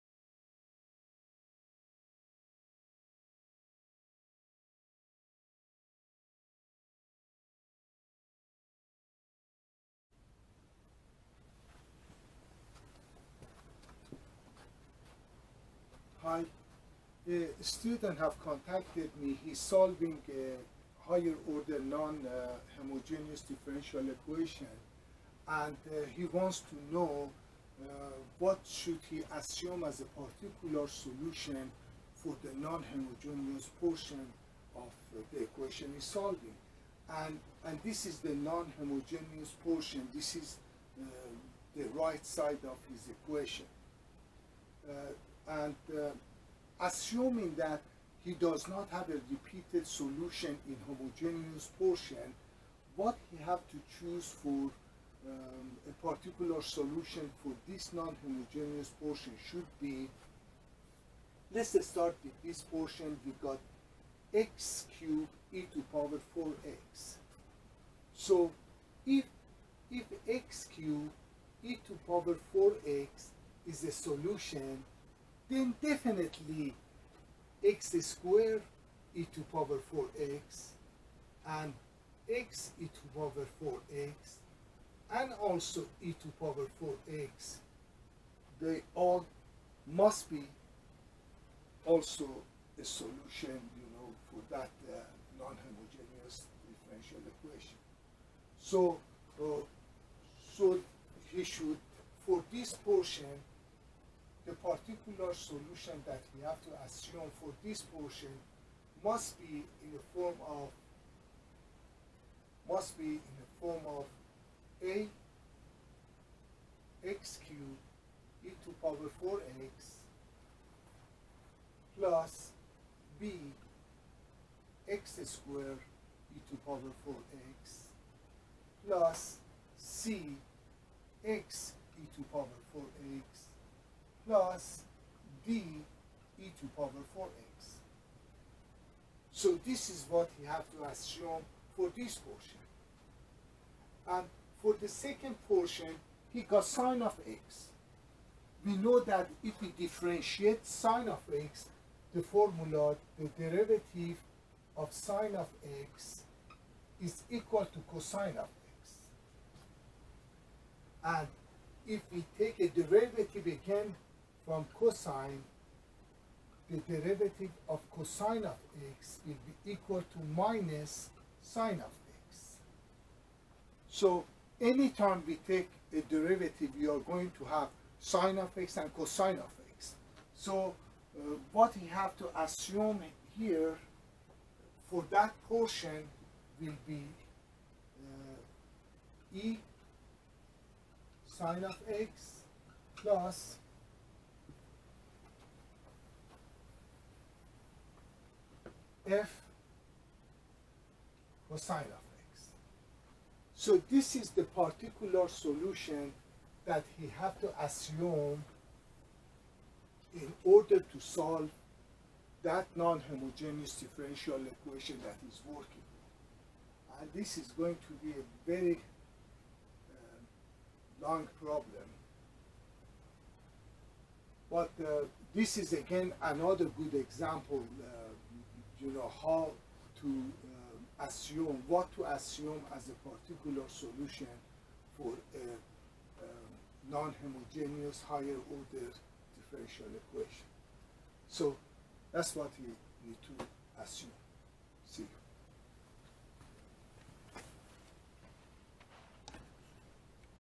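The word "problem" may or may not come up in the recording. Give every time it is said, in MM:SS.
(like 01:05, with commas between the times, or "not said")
03:41.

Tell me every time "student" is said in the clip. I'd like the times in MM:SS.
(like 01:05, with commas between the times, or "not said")
00:17.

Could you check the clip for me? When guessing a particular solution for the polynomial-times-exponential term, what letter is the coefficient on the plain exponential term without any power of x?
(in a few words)
d.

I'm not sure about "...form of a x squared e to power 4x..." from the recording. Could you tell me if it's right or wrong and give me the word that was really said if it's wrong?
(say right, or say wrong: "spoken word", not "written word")
wrong: "cubed", not "squared".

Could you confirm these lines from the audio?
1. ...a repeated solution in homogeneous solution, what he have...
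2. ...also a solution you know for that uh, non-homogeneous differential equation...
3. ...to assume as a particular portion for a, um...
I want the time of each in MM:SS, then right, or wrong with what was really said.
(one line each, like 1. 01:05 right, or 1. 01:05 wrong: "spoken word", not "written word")
1. 00:49 wrong: "portion", not "solution"
2. 01:31 right
3. 03:51 wrong: "solution", not "portion".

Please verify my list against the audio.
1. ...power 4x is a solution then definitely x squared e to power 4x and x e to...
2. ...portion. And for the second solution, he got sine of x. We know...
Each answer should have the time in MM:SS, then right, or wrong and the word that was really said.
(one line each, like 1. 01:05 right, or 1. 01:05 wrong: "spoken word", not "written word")
1. 01:12 right
2. 02:22 wrong: "portion", not "solution".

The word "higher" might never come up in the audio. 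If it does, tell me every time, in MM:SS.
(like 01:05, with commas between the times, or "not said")
00:21, 03:58.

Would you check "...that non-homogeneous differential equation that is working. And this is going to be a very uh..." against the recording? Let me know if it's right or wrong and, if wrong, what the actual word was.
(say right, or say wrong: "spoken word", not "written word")
right.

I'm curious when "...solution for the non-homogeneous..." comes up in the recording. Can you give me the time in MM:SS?
00:30.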